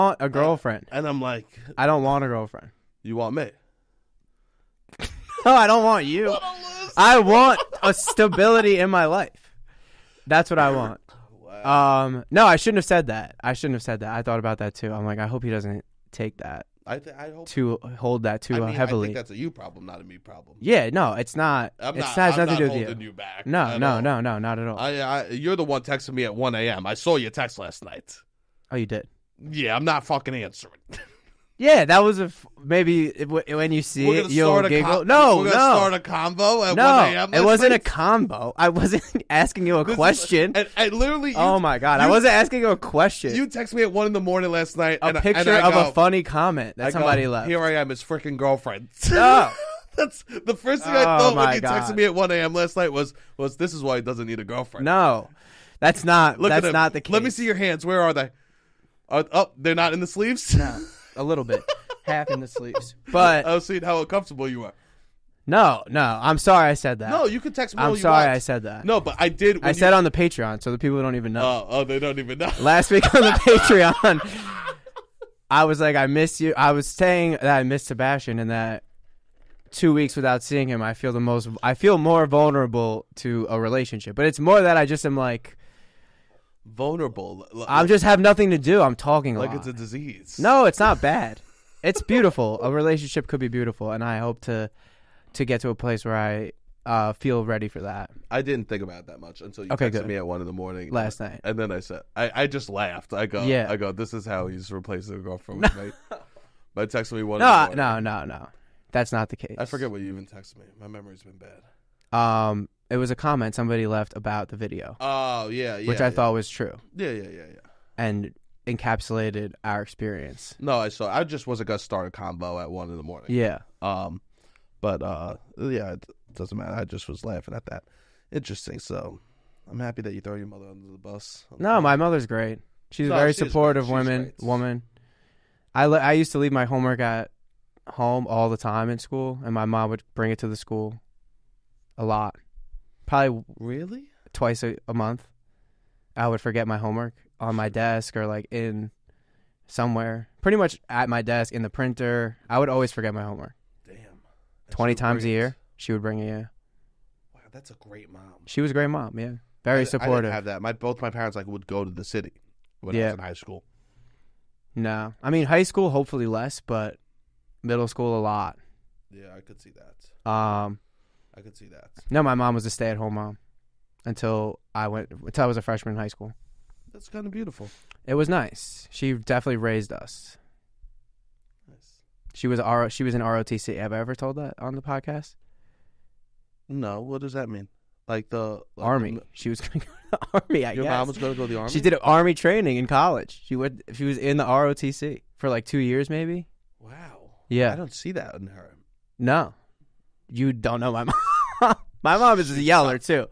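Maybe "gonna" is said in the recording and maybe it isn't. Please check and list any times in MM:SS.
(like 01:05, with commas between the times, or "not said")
00:35, 02:01.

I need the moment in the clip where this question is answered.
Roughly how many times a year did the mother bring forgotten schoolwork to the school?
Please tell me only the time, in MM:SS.
02:34.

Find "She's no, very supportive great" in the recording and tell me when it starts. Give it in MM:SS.
02:12.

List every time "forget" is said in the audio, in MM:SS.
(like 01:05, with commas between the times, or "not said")
01:49, 02:26, 02:32.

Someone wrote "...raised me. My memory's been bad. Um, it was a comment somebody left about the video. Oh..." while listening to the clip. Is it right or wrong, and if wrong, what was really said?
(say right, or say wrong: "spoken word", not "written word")
wrong: "texted", not "raised".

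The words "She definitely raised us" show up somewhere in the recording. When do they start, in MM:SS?
02:58.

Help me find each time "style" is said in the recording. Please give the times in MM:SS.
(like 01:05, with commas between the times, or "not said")
not said.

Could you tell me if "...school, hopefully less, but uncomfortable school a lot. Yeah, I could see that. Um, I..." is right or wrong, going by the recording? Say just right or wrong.
wrong.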